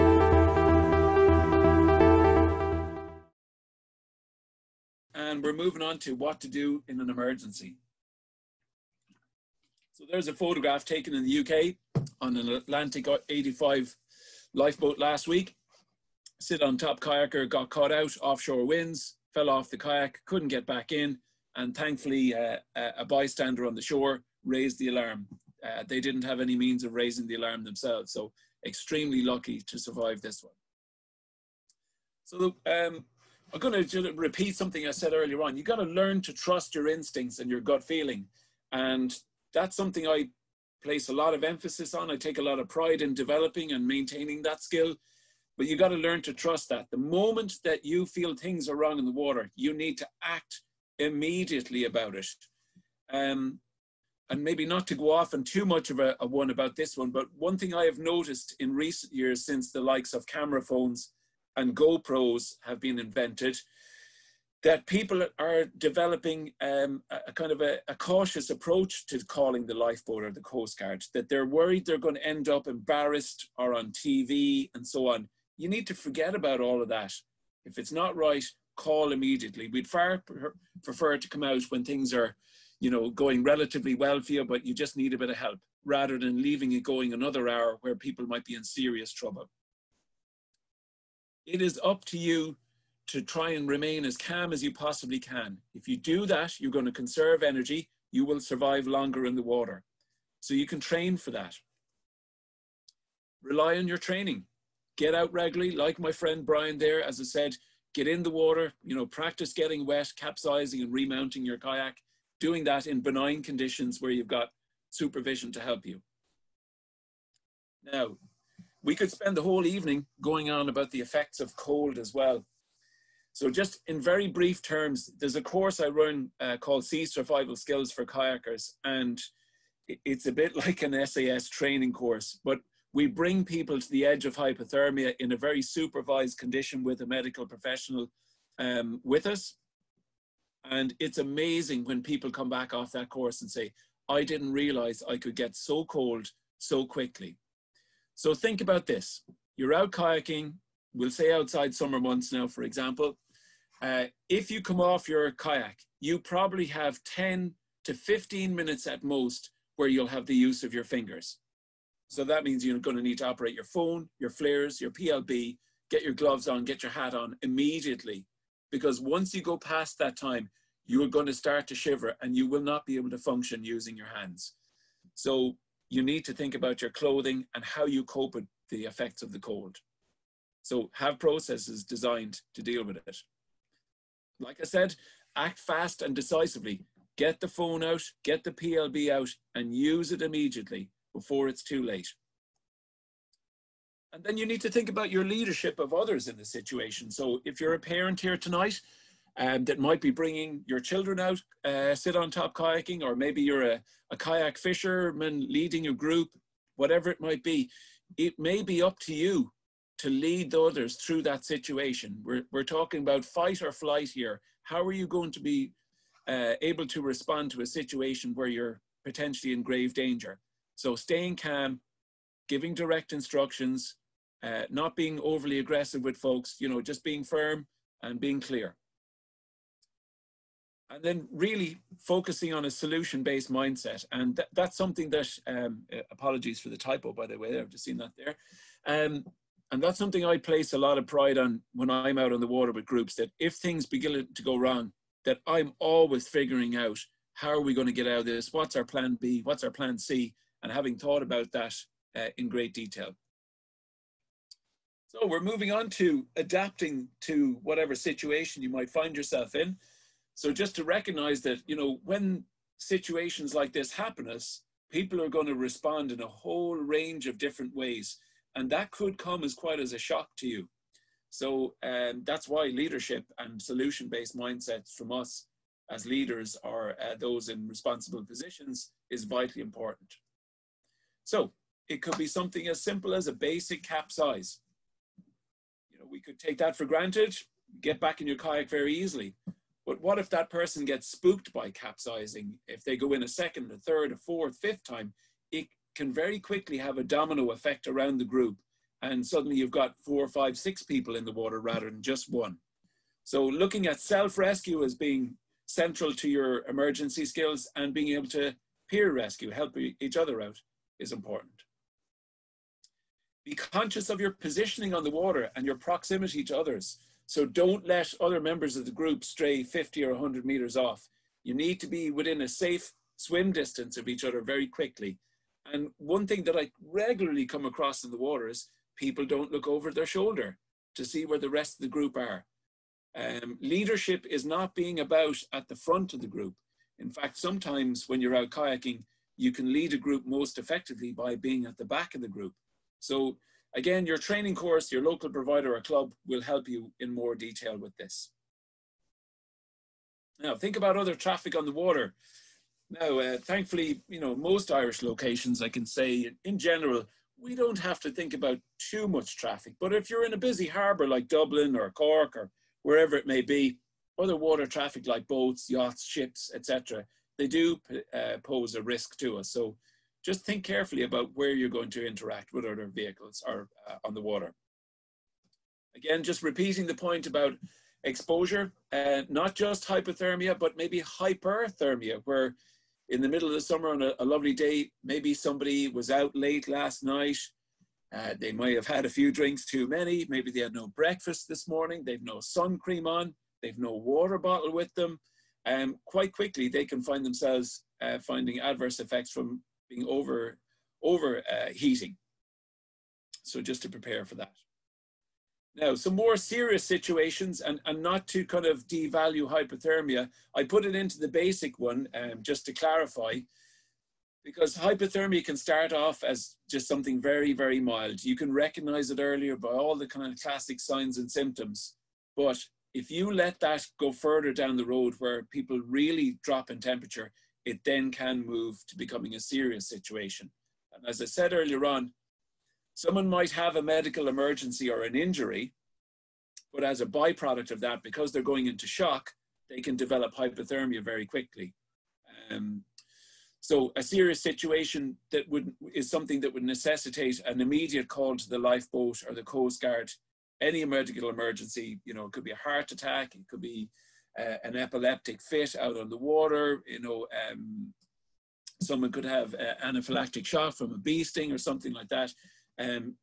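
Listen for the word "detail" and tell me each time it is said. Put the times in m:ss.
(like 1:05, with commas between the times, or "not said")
4:12, 5:47.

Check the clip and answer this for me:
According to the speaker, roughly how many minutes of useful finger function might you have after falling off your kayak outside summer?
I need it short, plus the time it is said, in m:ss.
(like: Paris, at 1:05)
10 to 15, at 2:37.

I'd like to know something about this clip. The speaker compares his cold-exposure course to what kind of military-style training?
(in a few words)
SAS training course.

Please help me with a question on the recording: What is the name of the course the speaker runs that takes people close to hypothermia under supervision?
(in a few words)
Sea Survival Skills for Kayakers.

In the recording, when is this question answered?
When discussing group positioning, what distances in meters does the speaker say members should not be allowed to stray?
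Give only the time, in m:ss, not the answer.
5:19.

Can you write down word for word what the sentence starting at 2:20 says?
And it's amazing when people come back off that course and say, I didn't realize I could get so cold so quickly.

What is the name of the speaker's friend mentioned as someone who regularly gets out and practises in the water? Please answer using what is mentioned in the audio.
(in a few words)
Brian.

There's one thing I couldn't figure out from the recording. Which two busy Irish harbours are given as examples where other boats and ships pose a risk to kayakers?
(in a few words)
Dublin or Cork.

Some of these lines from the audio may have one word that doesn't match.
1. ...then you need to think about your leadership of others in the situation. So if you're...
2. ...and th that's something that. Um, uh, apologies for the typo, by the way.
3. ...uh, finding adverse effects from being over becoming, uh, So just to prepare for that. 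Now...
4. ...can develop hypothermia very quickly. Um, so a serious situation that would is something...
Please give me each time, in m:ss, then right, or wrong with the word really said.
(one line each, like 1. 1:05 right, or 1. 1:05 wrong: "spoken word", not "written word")
1. 3:14 right
2. 3:54 right
3. 6:38 wrong: "overheating", not "becoming"
4. 7:19 right.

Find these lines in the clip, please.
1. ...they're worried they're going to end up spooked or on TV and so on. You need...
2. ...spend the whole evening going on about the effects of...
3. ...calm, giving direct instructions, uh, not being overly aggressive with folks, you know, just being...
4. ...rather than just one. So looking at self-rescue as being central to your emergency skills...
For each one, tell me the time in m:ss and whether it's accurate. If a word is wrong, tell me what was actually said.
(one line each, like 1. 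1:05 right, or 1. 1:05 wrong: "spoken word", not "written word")
1. 1:11 wrong: "embarrassed", not "spooked"
2. 1:59 right
3. 3:41 right
4. 5:01 right.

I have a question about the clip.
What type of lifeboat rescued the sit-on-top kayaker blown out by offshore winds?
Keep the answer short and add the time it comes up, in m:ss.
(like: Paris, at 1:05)
Atlantic 85, at 0:12.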